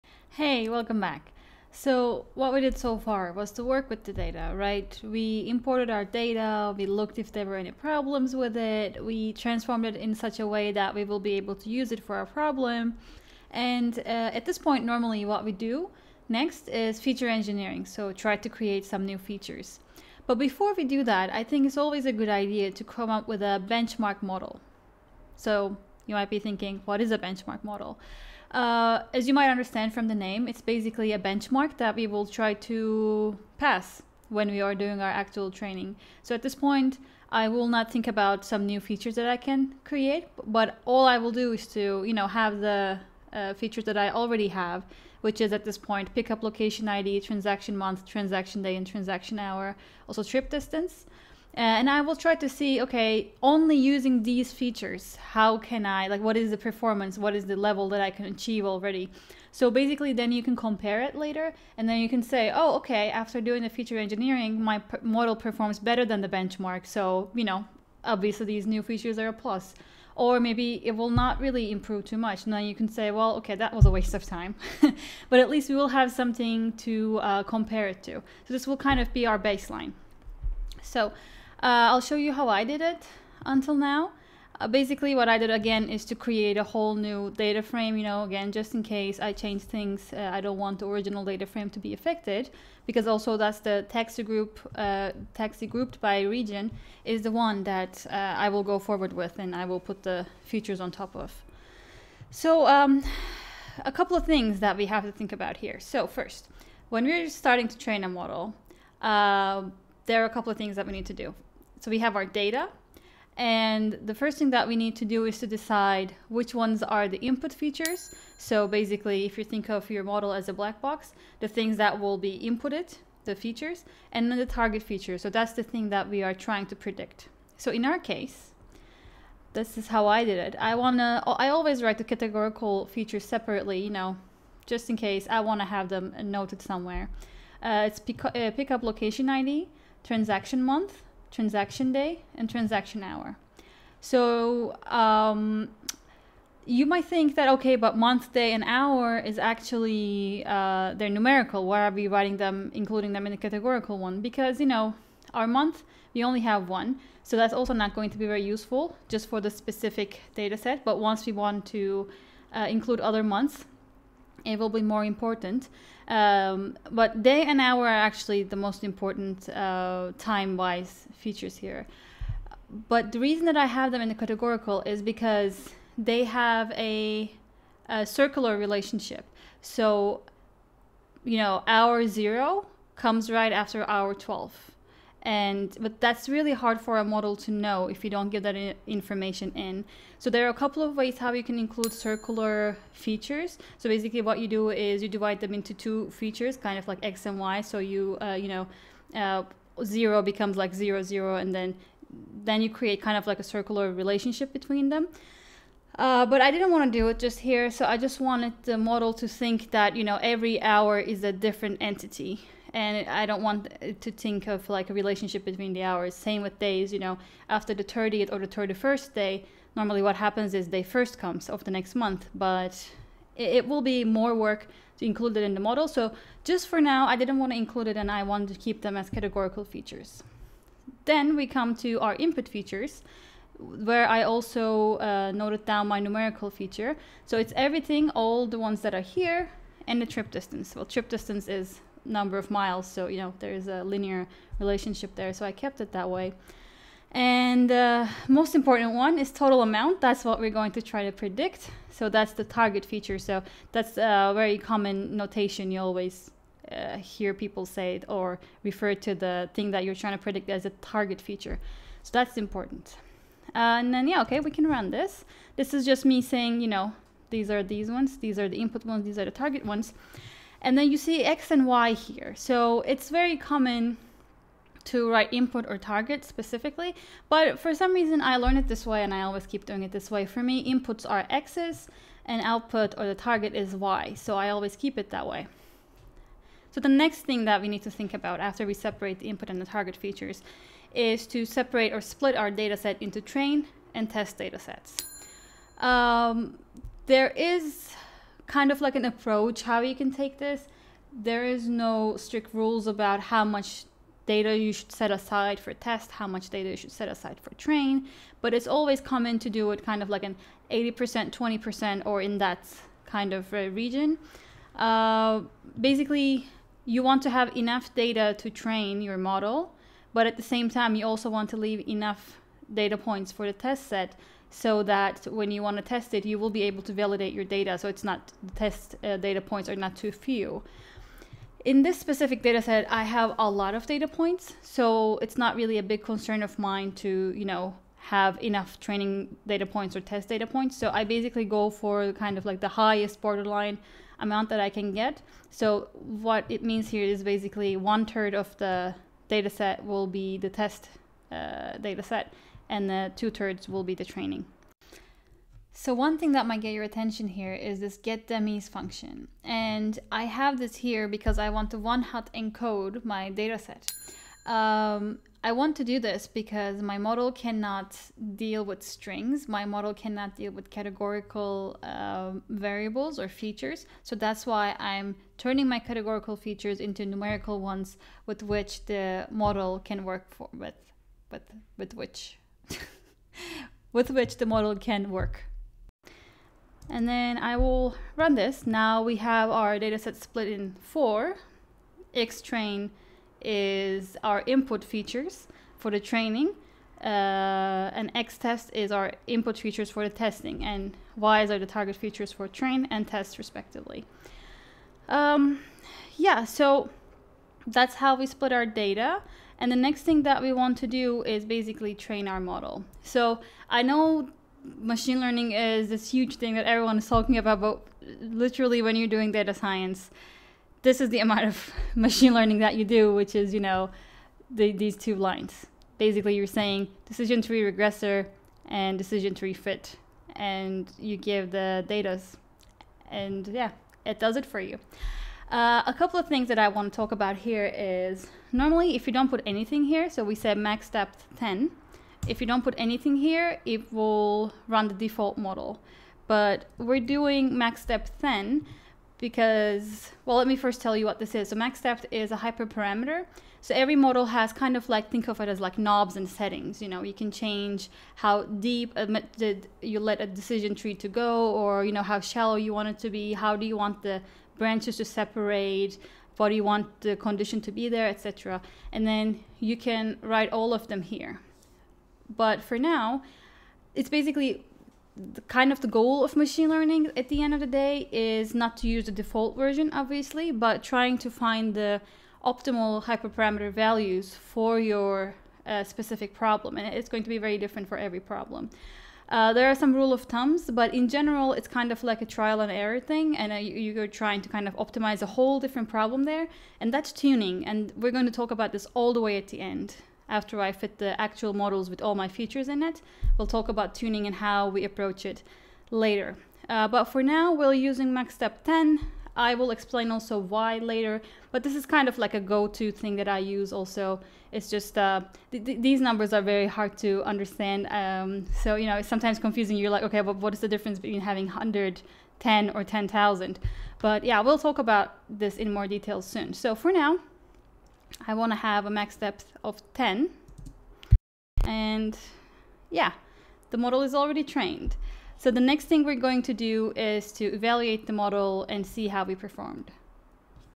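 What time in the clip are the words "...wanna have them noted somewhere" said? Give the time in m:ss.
2:15.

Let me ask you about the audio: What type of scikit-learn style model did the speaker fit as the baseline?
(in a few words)
decision tree regressor.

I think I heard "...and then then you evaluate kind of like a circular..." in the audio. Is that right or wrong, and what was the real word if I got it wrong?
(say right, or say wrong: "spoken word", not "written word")
wrong: "create", not "evaluate".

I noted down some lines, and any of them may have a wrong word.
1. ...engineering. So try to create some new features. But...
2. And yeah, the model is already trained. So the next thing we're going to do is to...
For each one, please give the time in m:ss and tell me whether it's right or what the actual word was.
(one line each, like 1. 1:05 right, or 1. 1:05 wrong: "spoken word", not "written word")
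1. 0:17 right
2. 8:51 right.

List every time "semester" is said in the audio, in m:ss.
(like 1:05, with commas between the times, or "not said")
not said.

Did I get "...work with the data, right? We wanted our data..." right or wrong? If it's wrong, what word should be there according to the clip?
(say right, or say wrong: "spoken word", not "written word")
wrong: "imported", not "wanted".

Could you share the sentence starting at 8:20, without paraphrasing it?
After I fit the actual models with all my features in it, we'll talk about tuning and how we approach it later.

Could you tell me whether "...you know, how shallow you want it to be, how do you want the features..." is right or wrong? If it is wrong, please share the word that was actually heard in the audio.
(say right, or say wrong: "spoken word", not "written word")
wrong: "branches", not "features".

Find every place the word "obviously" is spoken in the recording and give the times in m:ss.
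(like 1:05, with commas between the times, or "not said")
1:08, 7:59.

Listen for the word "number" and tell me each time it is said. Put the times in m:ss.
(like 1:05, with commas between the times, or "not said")
4:02, 8:36.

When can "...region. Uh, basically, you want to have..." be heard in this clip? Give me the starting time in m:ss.
5:13.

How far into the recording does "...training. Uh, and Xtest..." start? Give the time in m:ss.
6:35.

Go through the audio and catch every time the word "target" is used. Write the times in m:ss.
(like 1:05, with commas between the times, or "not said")
2:04, 4:12, 4:20, 4:29, 4:35, 4:43, 4:49, 6:41.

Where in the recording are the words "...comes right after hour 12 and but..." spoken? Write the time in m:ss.
3:02.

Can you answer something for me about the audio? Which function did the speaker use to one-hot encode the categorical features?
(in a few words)
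get dummies.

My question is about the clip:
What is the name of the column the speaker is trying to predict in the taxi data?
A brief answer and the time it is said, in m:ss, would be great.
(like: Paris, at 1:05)
total amount, at 4:09.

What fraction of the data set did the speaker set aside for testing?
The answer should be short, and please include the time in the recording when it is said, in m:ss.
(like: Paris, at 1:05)
one third, at 5:47.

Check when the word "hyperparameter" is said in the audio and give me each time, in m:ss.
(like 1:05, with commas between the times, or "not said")
7:32, 8:03.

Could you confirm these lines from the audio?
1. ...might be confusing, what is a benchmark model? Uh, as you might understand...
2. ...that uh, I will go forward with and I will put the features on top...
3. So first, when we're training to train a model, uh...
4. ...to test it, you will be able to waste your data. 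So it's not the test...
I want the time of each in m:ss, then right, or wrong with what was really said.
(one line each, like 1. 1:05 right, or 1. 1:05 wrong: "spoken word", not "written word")
1. 0:26 wrong: "thinking", not "confusing"
2. 1:37 right
3. 1:45 wrong: "starting", not "training"
4. 5:25 wrong: "validate", not "waste".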